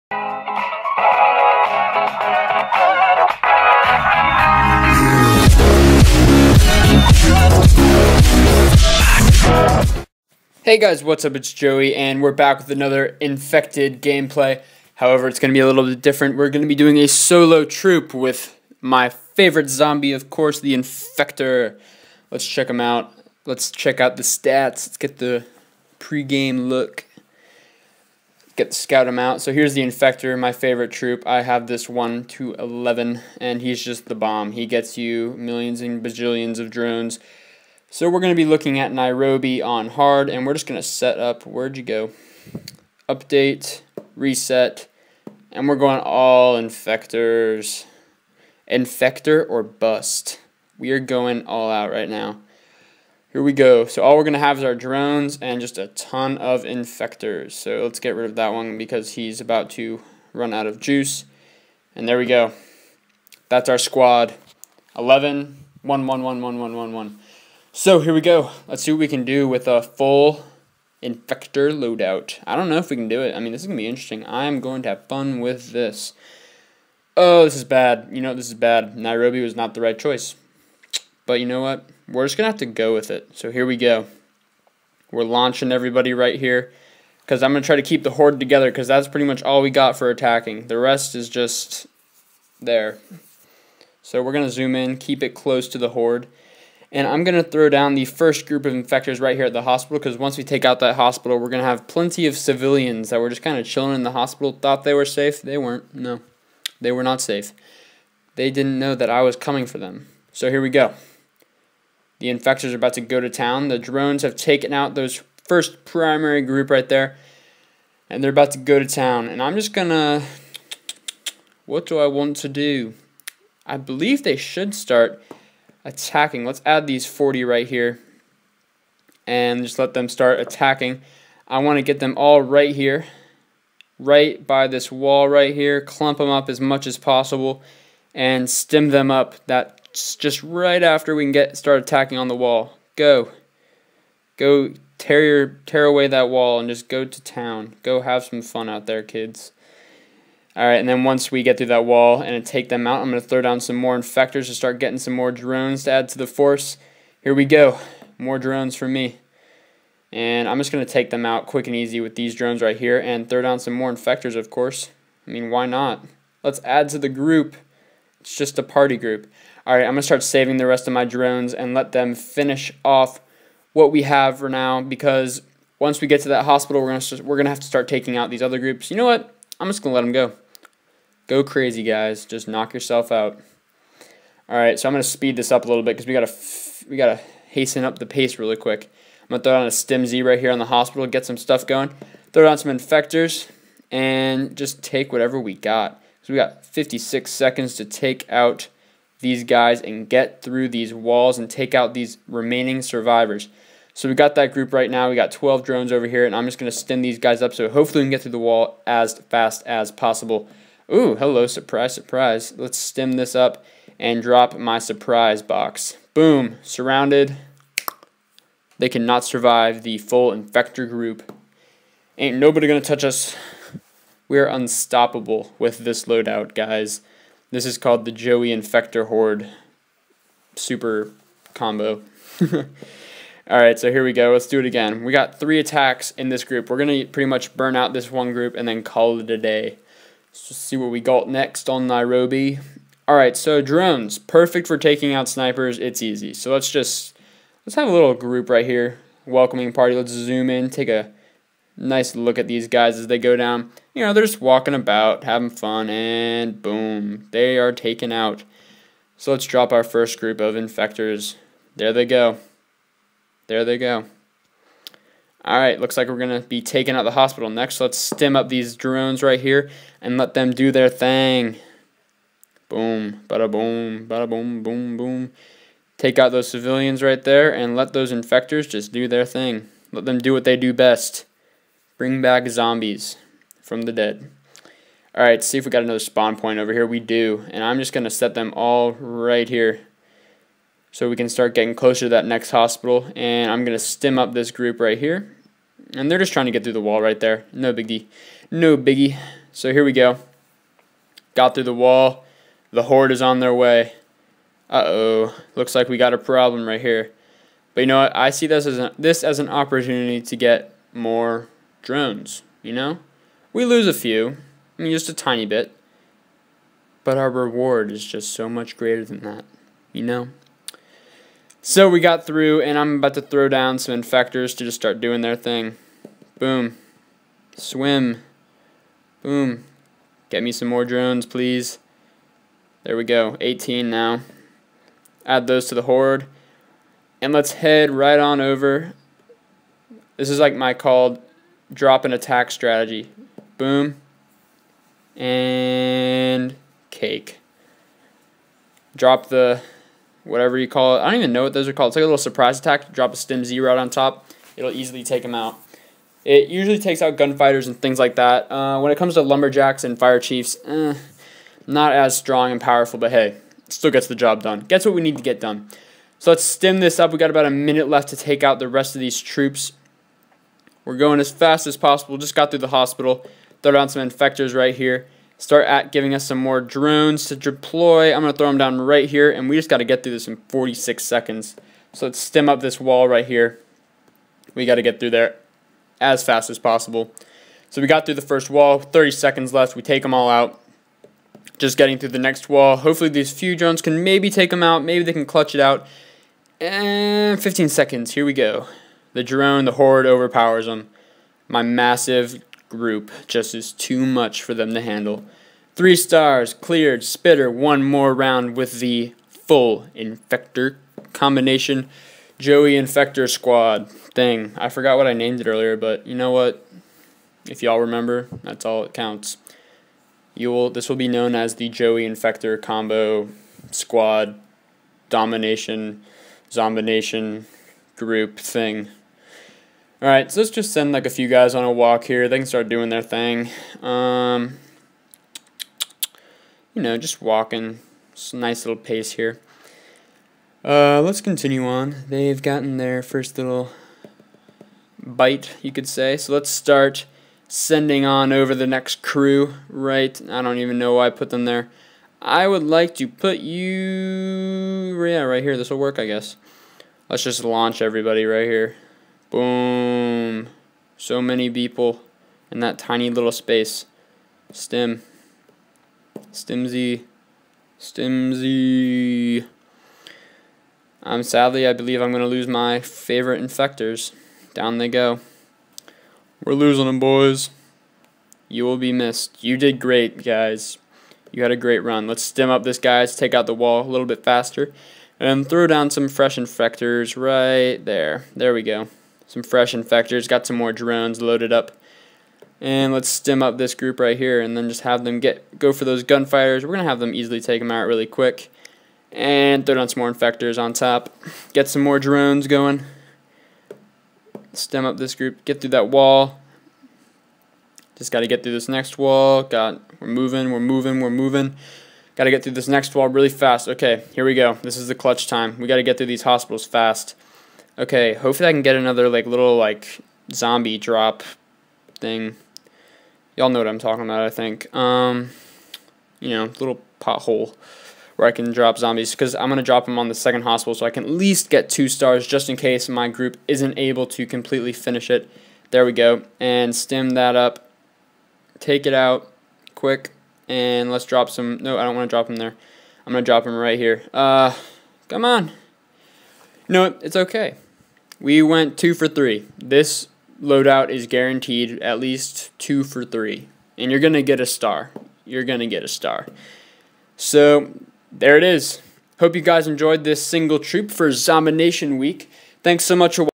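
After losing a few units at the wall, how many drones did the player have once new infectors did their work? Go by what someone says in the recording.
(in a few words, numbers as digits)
18.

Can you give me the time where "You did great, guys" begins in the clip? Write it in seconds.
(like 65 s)
479 s.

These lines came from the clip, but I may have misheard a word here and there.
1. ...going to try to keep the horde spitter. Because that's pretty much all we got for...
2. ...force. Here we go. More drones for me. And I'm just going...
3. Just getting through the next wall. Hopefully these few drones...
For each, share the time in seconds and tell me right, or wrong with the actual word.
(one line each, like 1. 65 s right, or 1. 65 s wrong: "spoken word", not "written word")
1. 87 s wrong: "together", not "spitter"
2. 156 s right
3. 391 s right.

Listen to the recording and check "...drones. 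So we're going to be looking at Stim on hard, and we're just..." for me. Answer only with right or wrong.
wrong.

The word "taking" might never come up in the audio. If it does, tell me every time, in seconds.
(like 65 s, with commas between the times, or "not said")
177 s, 244 s, 266 s.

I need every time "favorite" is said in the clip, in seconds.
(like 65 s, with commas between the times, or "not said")
19 s, 30 s, 472 s.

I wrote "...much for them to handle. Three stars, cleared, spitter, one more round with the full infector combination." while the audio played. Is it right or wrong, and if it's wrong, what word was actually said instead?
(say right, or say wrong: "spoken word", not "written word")
right.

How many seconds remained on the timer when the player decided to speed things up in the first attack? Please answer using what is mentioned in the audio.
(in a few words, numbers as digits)
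56.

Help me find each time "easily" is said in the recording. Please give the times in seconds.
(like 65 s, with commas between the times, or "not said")
354 s, 497 s.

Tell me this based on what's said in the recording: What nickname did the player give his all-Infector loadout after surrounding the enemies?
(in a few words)
Joey Infector Horde super combo.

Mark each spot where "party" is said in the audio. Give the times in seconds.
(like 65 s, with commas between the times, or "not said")
168 s, 249 s.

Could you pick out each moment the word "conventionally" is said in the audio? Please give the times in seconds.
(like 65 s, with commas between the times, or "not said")
not said.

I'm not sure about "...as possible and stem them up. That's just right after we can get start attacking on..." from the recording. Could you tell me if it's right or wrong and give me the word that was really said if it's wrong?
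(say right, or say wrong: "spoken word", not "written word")
right.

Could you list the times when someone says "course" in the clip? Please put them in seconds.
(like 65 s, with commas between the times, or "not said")
20 s, 164 s.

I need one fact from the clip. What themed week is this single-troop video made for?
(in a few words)
Zombination Week.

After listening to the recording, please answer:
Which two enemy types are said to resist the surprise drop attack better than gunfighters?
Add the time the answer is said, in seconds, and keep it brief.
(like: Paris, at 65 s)
Lumberjacks and fire chiefs, at 359 s.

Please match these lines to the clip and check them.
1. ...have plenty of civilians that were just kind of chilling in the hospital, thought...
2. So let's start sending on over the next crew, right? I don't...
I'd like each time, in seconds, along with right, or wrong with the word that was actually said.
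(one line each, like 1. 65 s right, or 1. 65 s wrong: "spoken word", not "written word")
1. 101 s right
2. 446 s right.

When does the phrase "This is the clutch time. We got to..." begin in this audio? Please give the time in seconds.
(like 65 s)
514 s.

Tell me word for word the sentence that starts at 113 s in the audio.
The drones have taken out those first primary group right there.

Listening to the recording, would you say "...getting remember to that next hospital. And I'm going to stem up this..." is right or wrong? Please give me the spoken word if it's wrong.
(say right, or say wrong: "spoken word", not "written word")
wrong: "closer", not "remember".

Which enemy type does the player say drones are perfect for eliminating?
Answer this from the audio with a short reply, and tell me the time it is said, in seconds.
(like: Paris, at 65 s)
Snipers, at 245 s.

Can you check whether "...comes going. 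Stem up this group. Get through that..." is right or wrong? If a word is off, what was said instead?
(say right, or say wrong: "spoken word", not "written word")
wrong: "drones", not "comes".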